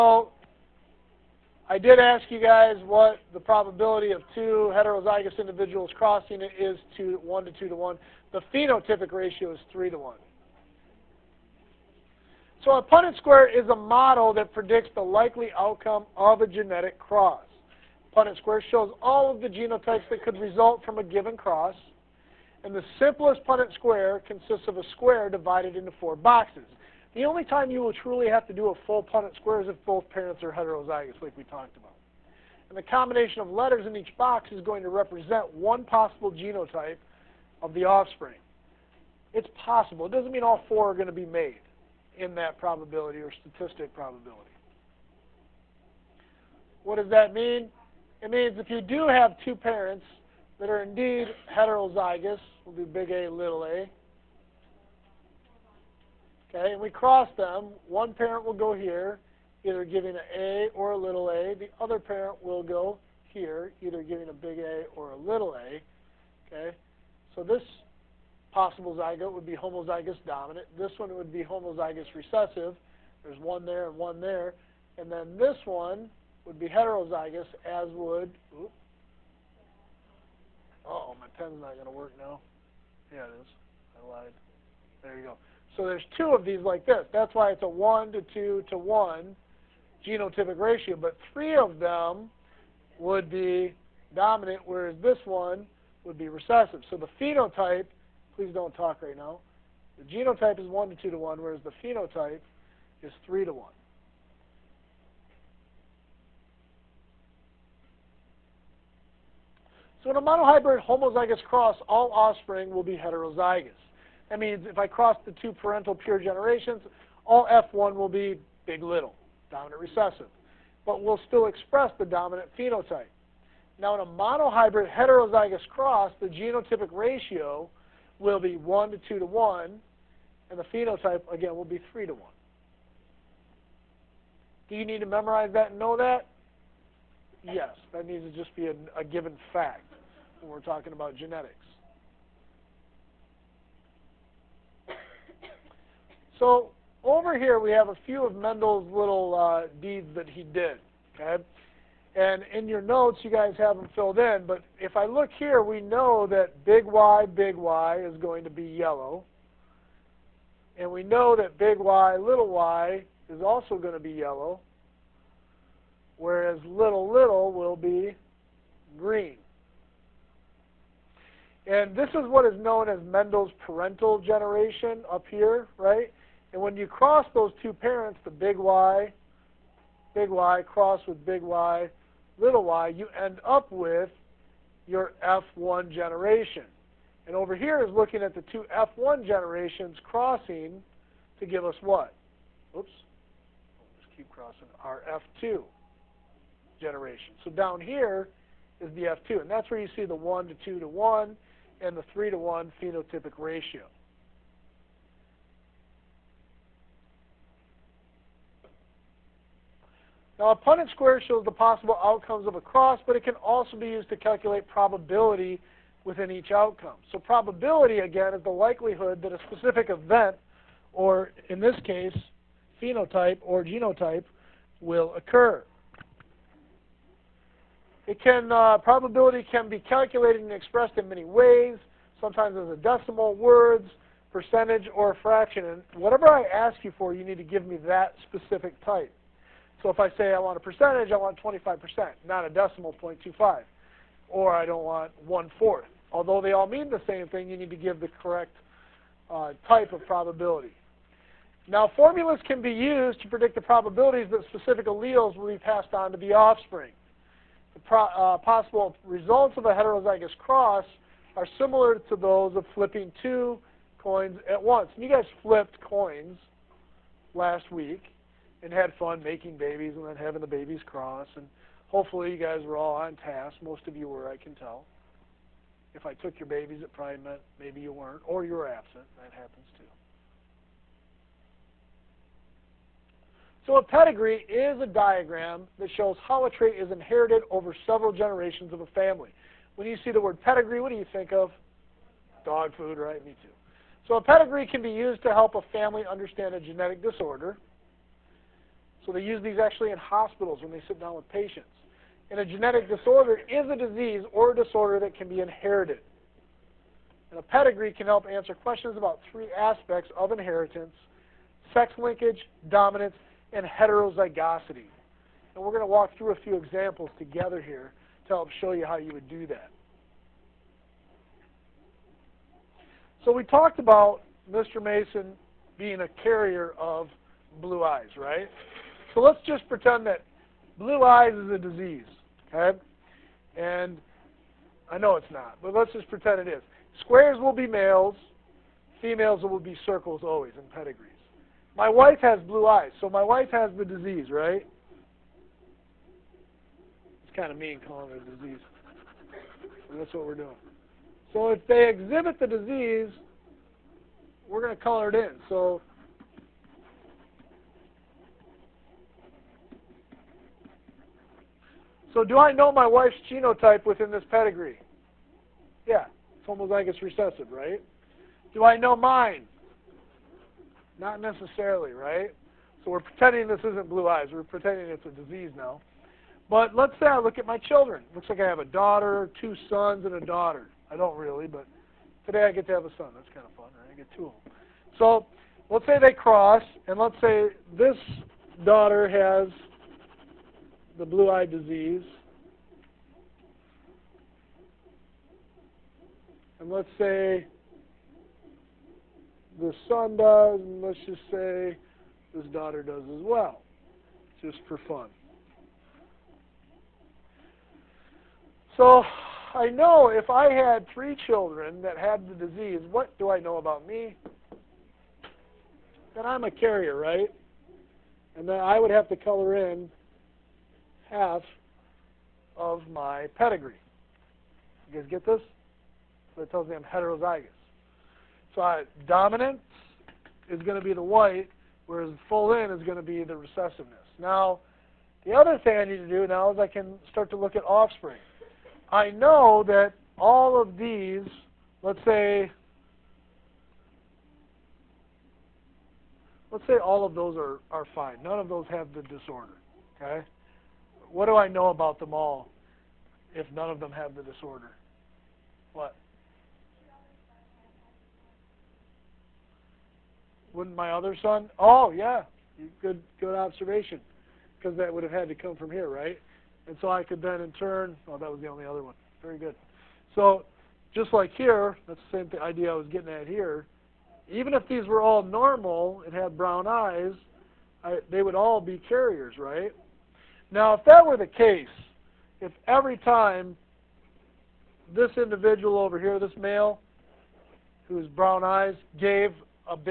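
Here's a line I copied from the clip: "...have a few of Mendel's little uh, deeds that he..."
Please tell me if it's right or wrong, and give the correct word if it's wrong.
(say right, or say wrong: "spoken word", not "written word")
right.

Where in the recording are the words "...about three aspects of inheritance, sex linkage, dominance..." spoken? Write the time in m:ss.
5:08.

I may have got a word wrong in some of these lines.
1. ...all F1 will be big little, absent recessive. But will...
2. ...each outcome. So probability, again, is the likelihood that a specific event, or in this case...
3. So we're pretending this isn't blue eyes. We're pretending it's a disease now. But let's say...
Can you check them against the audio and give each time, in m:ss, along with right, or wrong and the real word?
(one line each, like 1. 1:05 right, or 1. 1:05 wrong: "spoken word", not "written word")
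1. 1:57 wrong: "dominant", not "absent"
2. 3:36 right
3. 6:12 right.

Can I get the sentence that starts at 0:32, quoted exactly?
And the combination of letters in each box is going to represent one possible genotype of the offspring.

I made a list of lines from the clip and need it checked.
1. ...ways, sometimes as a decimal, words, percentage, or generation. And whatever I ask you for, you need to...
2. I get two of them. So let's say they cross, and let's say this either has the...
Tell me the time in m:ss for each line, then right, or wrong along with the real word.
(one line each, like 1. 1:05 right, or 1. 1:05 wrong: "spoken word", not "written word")
1. 3:51 wrong: "fraction", not "generation"
2. 6:23 wrong: "daughter", not "either".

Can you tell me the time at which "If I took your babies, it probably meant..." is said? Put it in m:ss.
4:35.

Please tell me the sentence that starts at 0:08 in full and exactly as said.
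The phenotypic ratio is 3 to 1.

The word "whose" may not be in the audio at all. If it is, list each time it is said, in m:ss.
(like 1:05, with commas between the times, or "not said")
8:07.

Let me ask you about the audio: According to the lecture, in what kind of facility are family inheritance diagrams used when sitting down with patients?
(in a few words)
Hospitals.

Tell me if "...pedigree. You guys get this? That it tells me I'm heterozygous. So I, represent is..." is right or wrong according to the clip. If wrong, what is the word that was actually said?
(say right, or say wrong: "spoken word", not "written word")
wrong: "dominant", not "represent".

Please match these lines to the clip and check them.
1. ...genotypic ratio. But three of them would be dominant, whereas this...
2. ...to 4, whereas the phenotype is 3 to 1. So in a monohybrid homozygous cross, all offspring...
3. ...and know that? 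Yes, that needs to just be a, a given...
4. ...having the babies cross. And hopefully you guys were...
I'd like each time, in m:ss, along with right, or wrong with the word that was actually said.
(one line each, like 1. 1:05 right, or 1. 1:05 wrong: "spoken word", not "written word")
1. 1:30 right
2. 1:41 wrong: "1", not "4"
3. 2:15 right
4. 4:30 right.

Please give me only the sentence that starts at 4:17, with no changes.
The uh, possible results of a heterozygous cross are similar to those of flipping two coins at once.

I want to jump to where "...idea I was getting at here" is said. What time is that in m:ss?
7:52.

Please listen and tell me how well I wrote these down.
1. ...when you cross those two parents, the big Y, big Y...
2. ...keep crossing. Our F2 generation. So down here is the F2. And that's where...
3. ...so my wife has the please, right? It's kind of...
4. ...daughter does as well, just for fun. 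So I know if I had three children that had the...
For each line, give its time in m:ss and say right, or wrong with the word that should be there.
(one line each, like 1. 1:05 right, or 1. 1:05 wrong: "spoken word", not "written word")
1. 2:56 right
2. 3:14 right
3. 5:42 wrong: "disease", not "please"
4. 6:42 right.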